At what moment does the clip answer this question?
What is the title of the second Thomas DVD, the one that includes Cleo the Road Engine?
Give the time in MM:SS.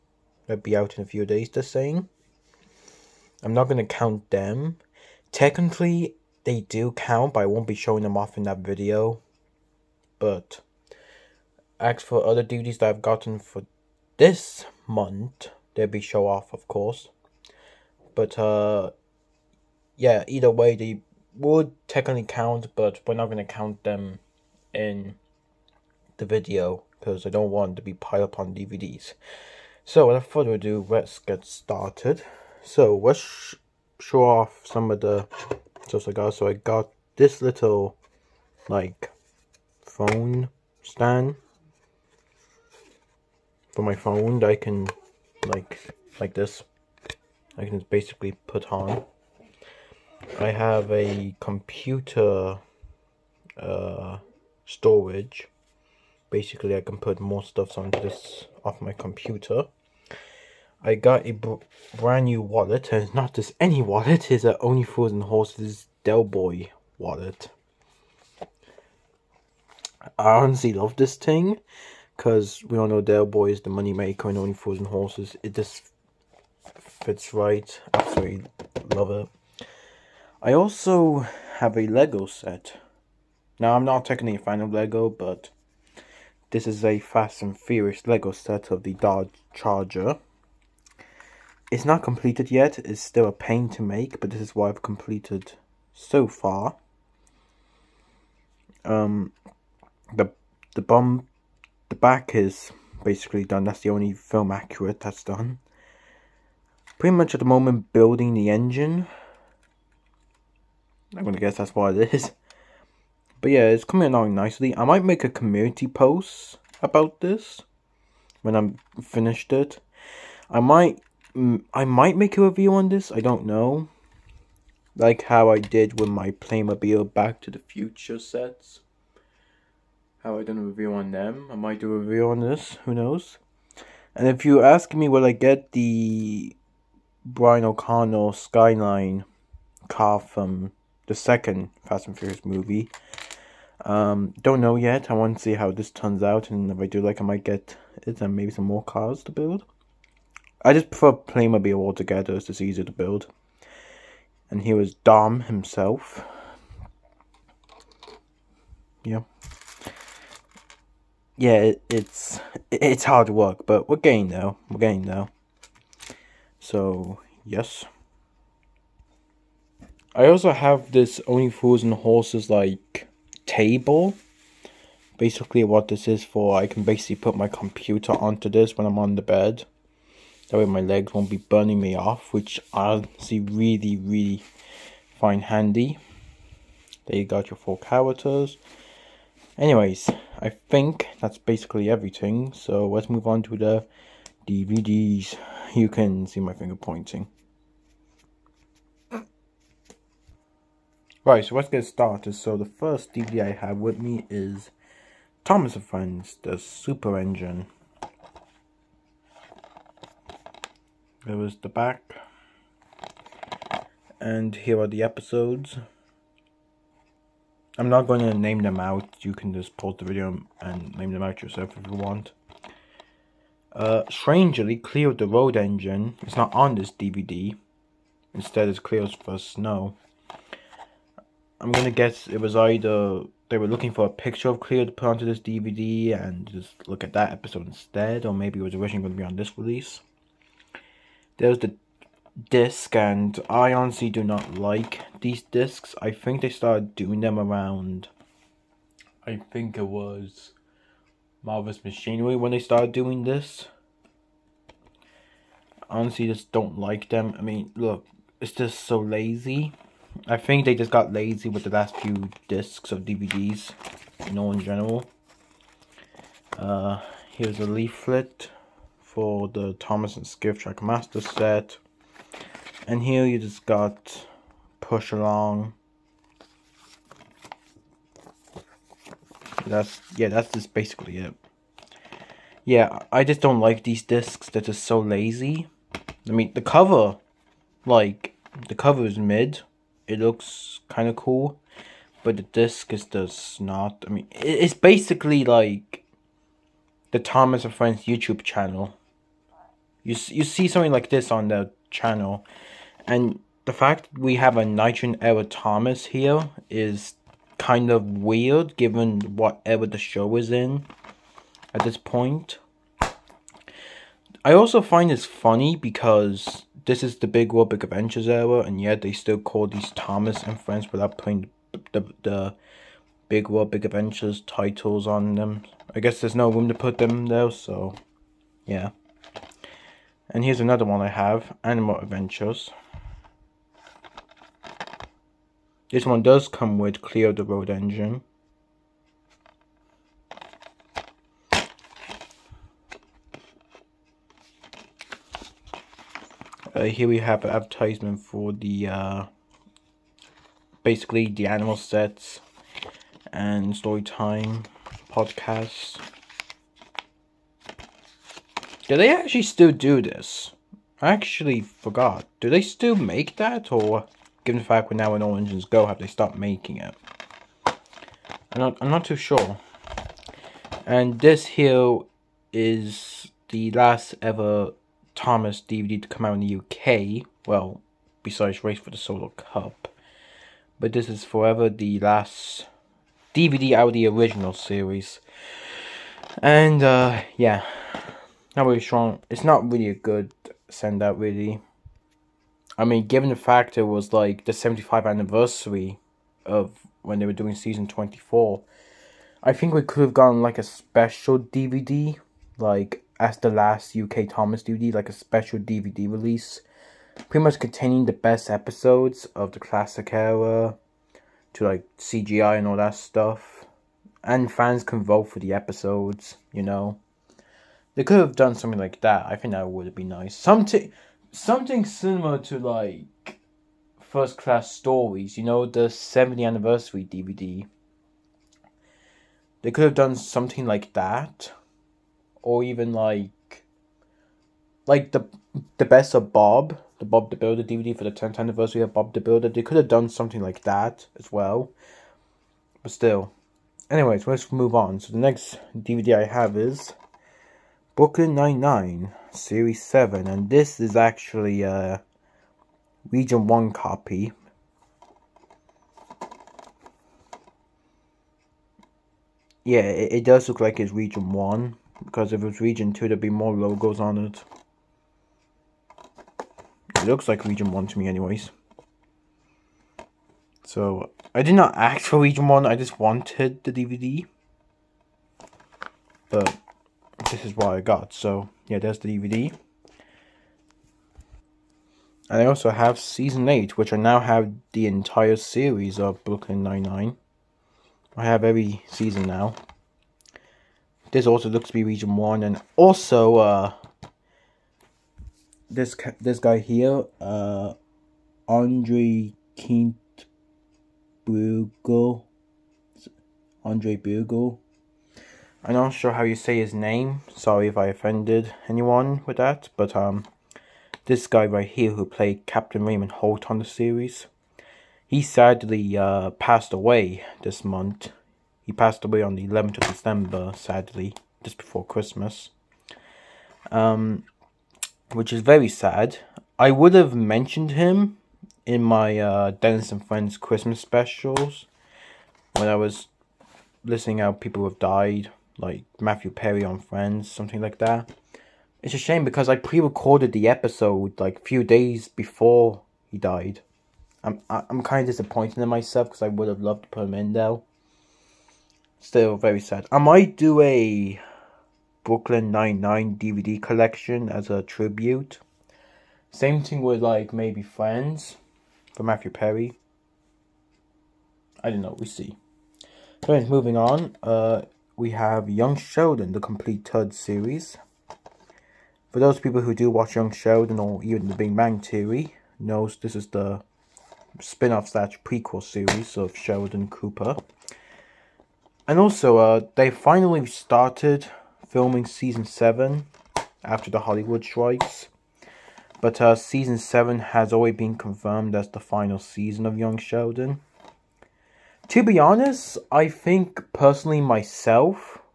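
05:31.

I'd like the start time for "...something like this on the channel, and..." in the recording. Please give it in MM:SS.
05:00.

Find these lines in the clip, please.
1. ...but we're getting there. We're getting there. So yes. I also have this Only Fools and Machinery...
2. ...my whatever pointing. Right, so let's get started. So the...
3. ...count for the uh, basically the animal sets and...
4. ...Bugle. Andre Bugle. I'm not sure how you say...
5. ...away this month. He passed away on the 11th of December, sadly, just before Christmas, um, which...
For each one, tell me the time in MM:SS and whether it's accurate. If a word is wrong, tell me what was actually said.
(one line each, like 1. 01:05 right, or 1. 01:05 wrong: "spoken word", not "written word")
1. 02:43 wrong: "Horses", not "Machinery"
2. 03:16 wrong: "finger", not "whatever"
3. 05:47 wrong: "advertisement", not "count"
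4. 08:21 right
5. 08:36 right.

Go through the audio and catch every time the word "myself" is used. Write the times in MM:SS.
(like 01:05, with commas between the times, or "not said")
09:05, 09:54.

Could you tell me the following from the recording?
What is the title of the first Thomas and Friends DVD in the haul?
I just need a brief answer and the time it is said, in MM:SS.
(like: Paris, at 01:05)
The Super Engine, at 03:26.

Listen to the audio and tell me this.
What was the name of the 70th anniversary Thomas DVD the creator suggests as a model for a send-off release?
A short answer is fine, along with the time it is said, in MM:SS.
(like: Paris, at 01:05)
First Class Stories, at 07:04.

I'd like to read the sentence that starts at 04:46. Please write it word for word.
I mean, the cover, like, the cover is mid it looks kind of cool, but the disc is does not.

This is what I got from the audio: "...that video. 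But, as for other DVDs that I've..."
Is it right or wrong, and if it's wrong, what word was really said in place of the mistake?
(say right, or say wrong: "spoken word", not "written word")
right.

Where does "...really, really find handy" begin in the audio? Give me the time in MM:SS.
03:03.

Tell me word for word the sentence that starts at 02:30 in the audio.
I just prefer Playmobil altogether; it's just easier to build.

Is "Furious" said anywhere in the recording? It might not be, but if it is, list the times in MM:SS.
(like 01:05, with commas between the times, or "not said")
01:27, 02:22.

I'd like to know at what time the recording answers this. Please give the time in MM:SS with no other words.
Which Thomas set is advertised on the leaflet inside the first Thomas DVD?
04:29.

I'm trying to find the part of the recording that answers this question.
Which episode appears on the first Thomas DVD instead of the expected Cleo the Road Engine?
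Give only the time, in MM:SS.
03:48.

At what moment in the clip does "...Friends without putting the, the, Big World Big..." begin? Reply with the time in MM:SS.
05:20.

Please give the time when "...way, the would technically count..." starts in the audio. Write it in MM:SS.
00:20.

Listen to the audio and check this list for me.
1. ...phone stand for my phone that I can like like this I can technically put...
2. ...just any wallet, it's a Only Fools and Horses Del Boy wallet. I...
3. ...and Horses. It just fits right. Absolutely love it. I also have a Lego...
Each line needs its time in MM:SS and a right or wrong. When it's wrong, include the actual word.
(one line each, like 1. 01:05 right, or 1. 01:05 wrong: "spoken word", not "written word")
1. 00:39 wrong: "basically", not "technically"
2. 01:03 right
3. 01:14 right.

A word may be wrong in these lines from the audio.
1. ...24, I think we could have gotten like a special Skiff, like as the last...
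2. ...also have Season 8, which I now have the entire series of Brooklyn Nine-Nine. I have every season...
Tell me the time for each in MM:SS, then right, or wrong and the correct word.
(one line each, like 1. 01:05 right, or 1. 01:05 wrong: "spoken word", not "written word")
1. 06:37 wrong: "DVD", not "Skiff"
2. 08:02 right.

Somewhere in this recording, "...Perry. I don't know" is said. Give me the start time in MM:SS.
09:19.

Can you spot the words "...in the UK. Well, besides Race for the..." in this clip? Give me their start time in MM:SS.
06:16.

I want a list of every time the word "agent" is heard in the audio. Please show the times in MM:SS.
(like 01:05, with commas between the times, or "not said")
not said.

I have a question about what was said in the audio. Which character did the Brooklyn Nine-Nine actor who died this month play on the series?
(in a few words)
Captain Raymond Holt.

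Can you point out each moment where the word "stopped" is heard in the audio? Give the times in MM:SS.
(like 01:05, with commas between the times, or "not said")
06:06.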